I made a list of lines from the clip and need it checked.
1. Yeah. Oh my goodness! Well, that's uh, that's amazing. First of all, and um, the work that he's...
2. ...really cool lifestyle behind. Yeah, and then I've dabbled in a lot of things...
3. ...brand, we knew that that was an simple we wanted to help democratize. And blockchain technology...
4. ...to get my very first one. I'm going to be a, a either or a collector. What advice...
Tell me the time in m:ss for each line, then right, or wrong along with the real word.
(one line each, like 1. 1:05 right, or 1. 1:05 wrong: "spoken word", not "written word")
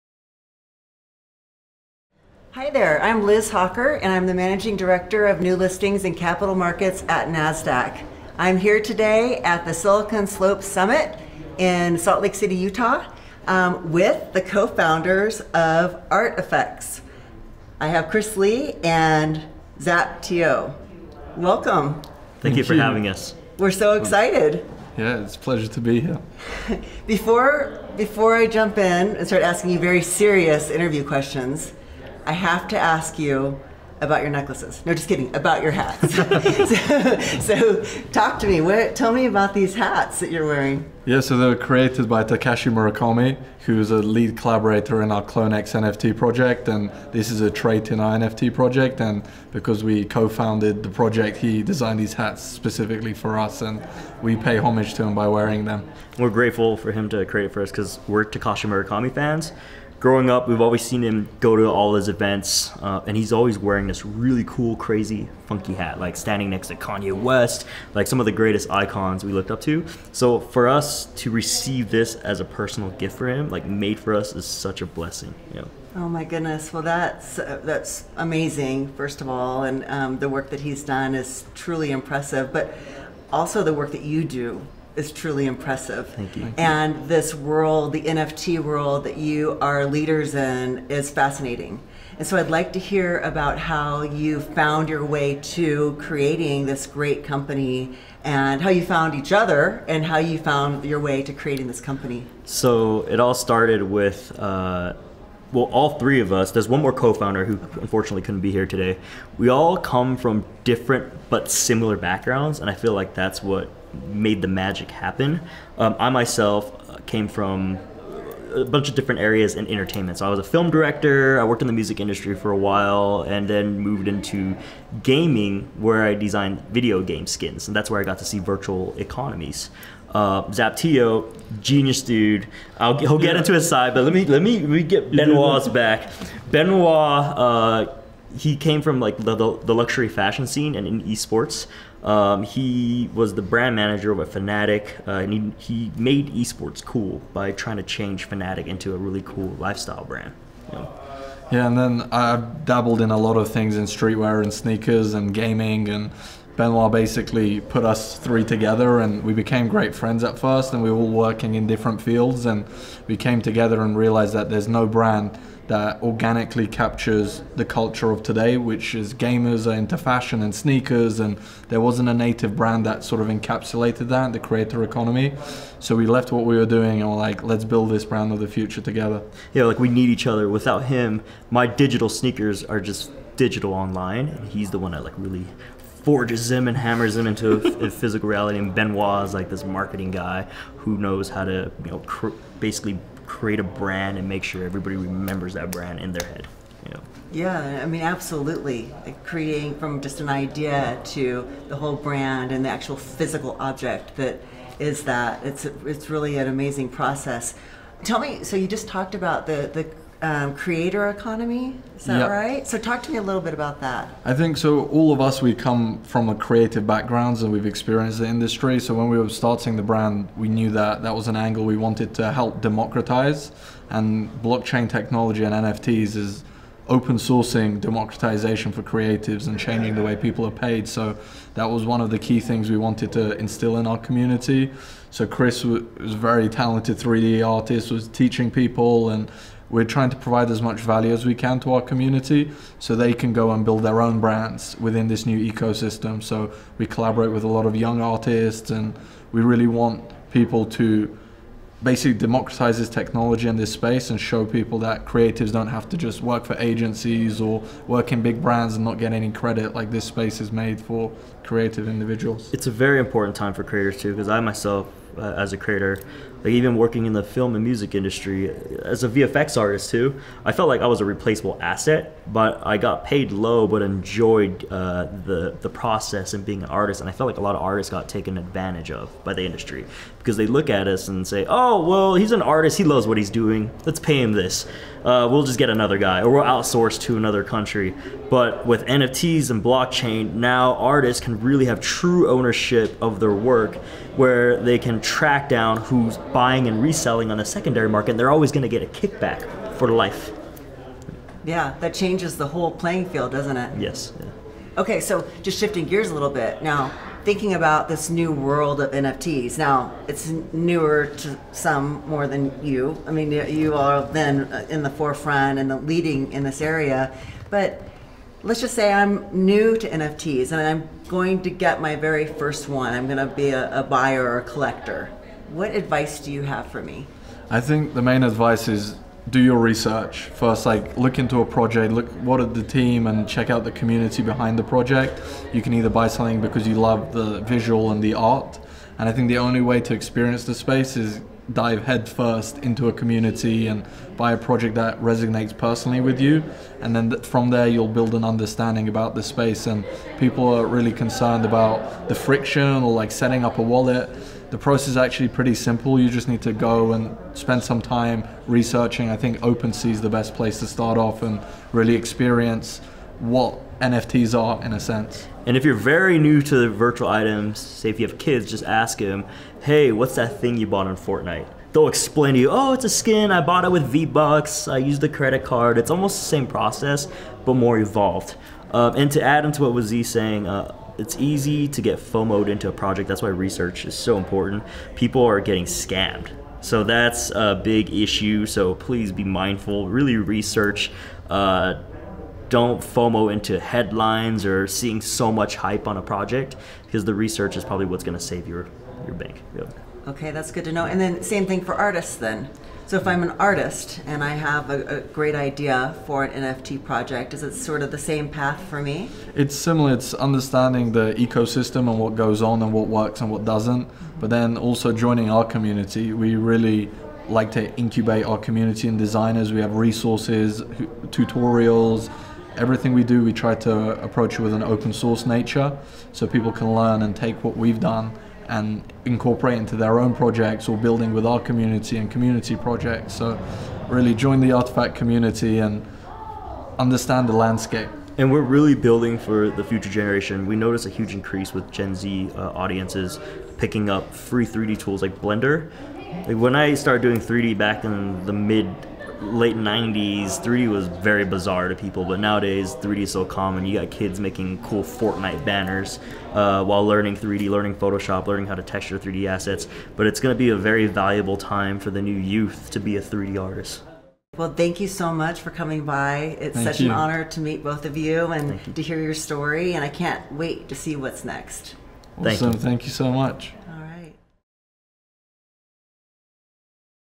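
1. 1:15 right
2. 2:28 wrong: "brand", not "behind"
3. 3:39 wrong: "angle", not "simple"
4. 5:21 wrong: "buyer", not "either".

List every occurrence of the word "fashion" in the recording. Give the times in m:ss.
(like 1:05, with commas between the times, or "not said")
2:20, 2:49.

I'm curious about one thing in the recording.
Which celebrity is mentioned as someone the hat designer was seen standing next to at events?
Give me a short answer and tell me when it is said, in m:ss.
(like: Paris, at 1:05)
Kanye West, at 1:06.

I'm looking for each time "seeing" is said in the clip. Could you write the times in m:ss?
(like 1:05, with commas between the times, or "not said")
6:34.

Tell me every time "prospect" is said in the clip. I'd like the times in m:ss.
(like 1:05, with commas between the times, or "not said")
not said.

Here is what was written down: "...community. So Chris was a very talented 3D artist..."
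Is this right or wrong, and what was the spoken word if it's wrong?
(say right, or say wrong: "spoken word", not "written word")
right.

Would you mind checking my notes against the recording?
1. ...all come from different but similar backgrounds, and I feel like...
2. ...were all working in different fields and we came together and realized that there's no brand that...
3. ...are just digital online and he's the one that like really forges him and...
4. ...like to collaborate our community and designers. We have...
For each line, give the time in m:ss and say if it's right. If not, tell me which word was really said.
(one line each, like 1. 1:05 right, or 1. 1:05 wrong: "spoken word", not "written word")
1. 1:49 right
2. 2:40 right
3. 3:02 right
4. 6:57 wrong: "incubate", not "collaborate".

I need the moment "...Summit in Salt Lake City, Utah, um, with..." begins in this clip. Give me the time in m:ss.
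0:10.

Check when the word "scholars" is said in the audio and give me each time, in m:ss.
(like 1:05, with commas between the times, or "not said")
not said.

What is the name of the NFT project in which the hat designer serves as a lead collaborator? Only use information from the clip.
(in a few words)
CloneX.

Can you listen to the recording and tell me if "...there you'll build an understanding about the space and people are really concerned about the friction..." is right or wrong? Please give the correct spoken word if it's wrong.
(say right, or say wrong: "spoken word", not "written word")
right.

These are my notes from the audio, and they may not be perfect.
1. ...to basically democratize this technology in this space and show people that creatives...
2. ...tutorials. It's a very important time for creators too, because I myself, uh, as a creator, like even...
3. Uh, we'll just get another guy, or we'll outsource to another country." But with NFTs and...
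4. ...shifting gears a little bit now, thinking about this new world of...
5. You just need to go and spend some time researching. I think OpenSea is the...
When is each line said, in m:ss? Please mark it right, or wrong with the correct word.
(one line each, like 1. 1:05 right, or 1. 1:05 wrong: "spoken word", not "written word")
1. 4:10 right
2. 4:21 wrong: "individuals", not "tutorials"
3. 4:45 right
4. 5:05 right
5. 5:55 right.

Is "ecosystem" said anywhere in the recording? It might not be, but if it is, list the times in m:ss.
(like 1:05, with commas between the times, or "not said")
4:05, 6:51.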